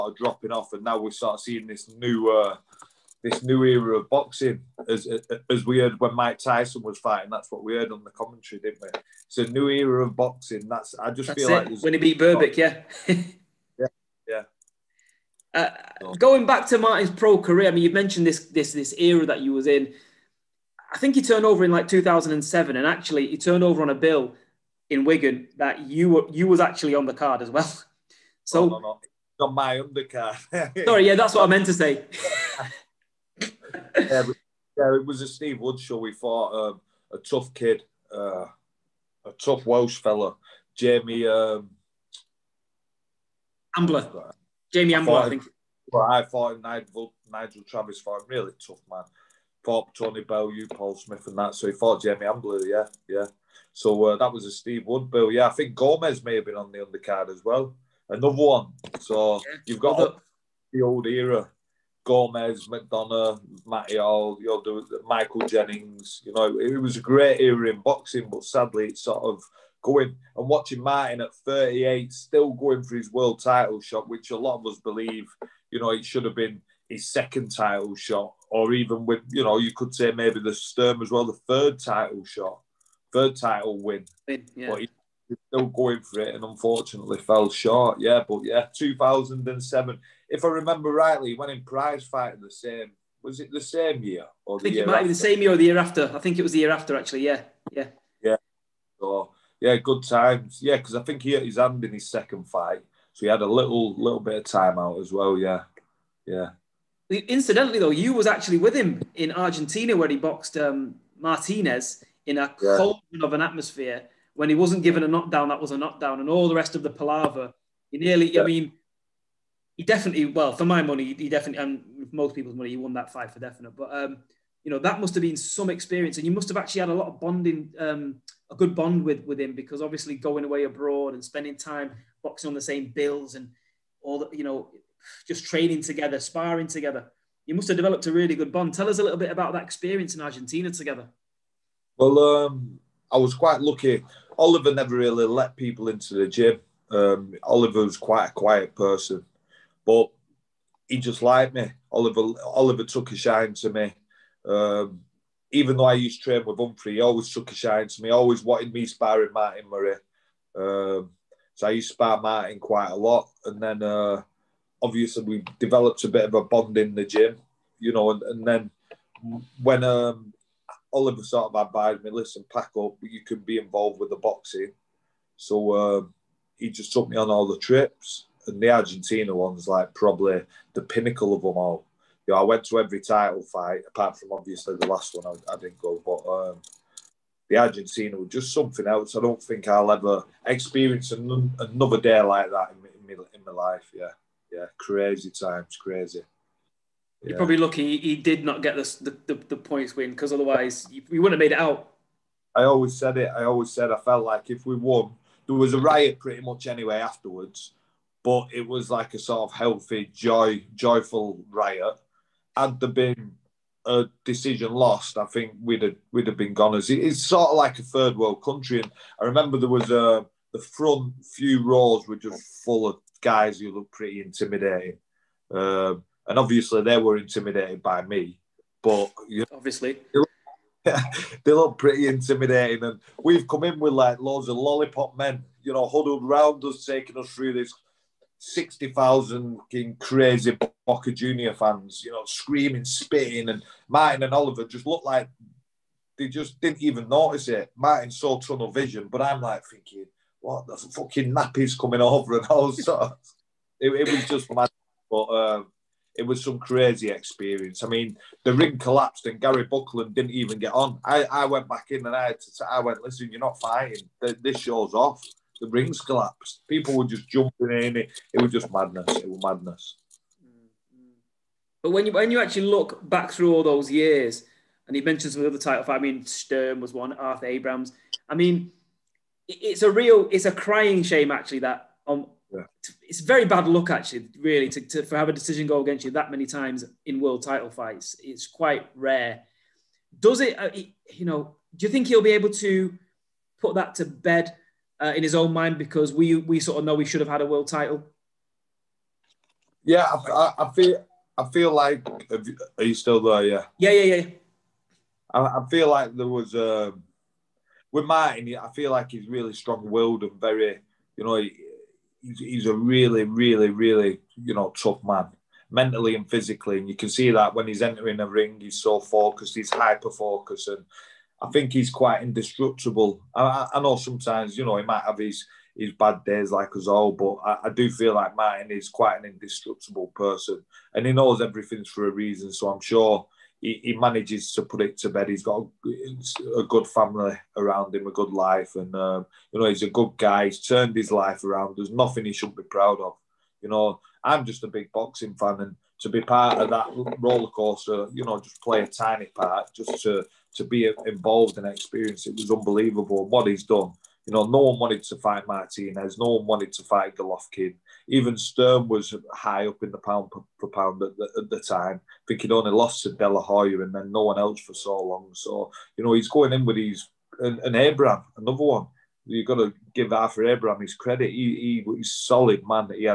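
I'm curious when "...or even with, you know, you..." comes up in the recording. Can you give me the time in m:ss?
1:18.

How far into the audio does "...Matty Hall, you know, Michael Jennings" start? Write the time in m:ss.
1:03.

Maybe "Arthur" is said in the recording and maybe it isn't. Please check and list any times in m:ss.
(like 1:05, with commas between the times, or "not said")
4:37, 6:10.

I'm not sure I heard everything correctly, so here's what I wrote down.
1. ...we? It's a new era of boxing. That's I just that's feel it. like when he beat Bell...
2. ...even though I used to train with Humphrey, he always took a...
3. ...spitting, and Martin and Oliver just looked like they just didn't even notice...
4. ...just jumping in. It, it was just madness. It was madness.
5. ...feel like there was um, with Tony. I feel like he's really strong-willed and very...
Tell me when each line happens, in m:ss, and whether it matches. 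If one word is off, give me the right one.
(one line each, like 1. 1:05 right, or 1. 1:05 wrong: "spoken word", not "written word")
1. 0:08 wrong: "Berbick", not "Bell"
2. 2:35 right
3. 4:02 right
4. 4:27 right
5. 5:05 wrong: "Martin", not "Tony".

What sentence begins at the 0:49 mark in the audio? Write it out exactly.
Fought Tony Bell, you, Paul Smith, and that.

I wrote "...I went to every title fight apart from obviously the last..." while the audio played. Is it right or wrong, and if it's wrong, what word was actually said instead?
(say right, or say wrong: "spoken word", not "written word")
right.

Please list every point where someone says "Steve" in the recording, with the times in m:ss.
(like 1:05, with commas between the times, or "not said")
0:35, 0:54.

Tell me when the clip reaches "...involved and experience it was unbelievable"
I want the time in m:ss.
5:51.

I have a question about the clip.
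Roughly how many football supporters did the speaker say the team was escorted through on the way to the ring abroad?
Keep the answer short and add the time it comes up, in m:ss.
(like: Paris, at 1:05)
60,000, at 3:58.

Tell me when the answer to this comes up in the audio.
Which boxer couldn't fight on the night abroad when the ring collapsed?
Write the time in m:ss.
4:19.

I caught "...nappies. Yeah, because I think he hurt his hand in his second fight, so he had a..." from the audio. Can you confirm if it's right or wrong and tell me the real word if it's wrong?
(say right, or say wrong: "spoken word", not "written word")
wrong: "times", not "nappies".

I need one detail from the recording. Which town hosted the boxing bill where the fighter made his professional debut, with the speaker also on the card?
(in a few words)
Wigan.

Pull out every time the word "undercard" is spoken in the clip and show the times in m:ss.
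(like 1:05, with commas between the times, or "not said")
0:29, 0:56.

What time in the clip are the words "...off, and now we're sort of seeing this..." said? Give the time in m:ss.
0:00.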